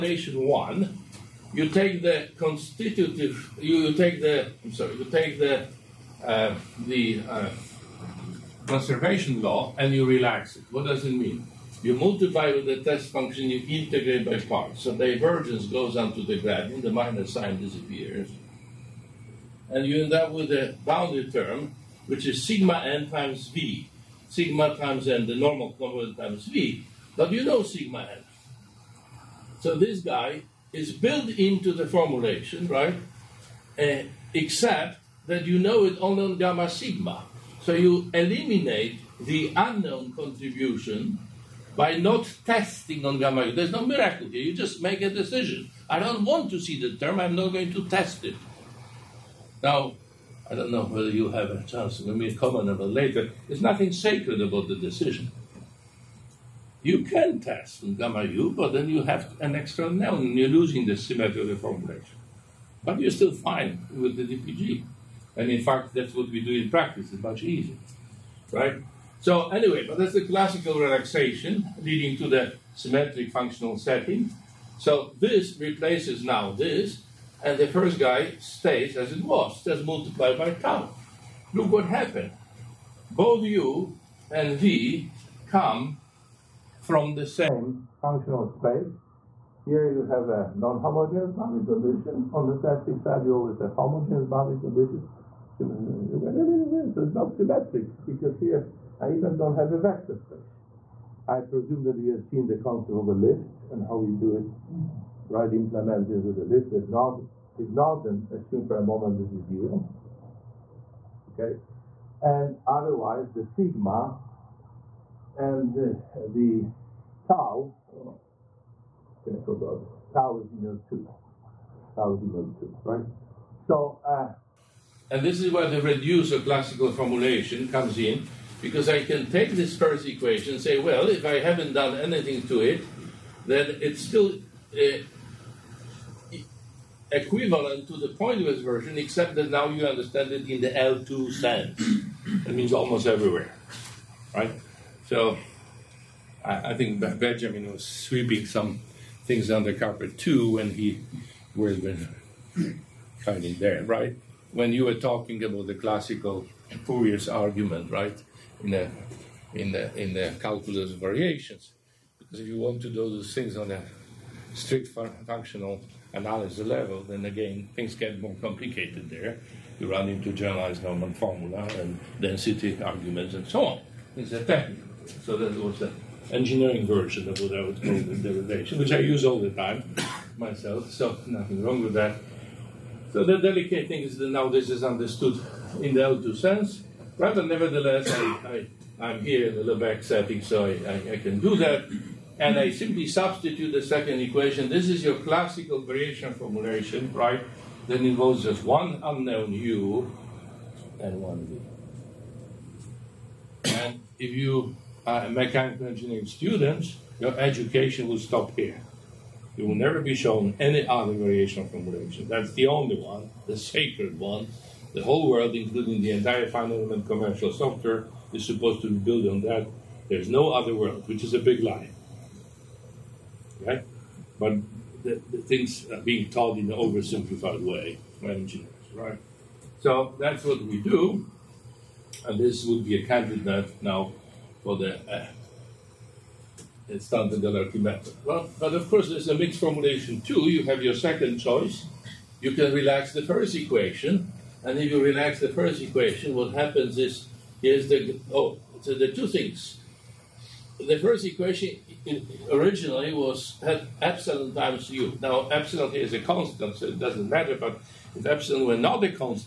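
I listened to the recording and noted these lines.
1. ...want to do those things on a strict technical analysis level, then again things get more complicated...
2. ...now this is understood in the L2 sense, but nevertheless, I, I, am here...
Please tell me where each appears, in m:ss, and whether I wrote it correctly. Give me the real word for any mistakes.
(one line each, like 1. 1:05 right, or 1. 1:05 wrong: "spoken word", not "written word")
1. 2:42 wrong: "functional", not "technical"
2. 3:04 right.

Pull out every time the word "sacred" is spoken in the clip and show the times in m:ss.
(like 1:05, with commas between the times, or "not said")
0:53, 3:33.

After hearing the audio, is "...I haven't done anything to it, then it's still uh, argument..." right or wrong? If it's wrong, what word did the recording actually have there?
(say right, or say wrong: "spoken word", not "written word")
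wrong: "equivalent", not "argument".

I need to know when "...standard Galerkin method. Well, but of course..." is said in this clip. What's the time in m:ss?
3:56.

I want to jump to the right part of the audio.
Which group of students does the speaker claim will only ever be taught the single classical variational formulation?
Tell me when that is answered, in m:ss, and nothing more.
3:25.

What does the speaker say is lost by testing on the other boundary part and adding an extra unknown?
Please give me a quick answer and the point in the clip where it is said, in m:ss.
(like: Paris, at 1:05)
the symmetry, at 1:00.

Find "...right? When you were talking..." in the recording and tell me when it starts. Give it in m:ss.
2:33.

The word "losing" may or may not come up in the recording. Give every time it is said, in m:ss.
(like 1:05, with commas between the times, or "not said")
1:00.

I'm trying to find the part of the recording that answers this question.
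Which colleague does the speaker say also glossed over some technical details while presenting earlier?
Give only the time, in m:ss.
2:27.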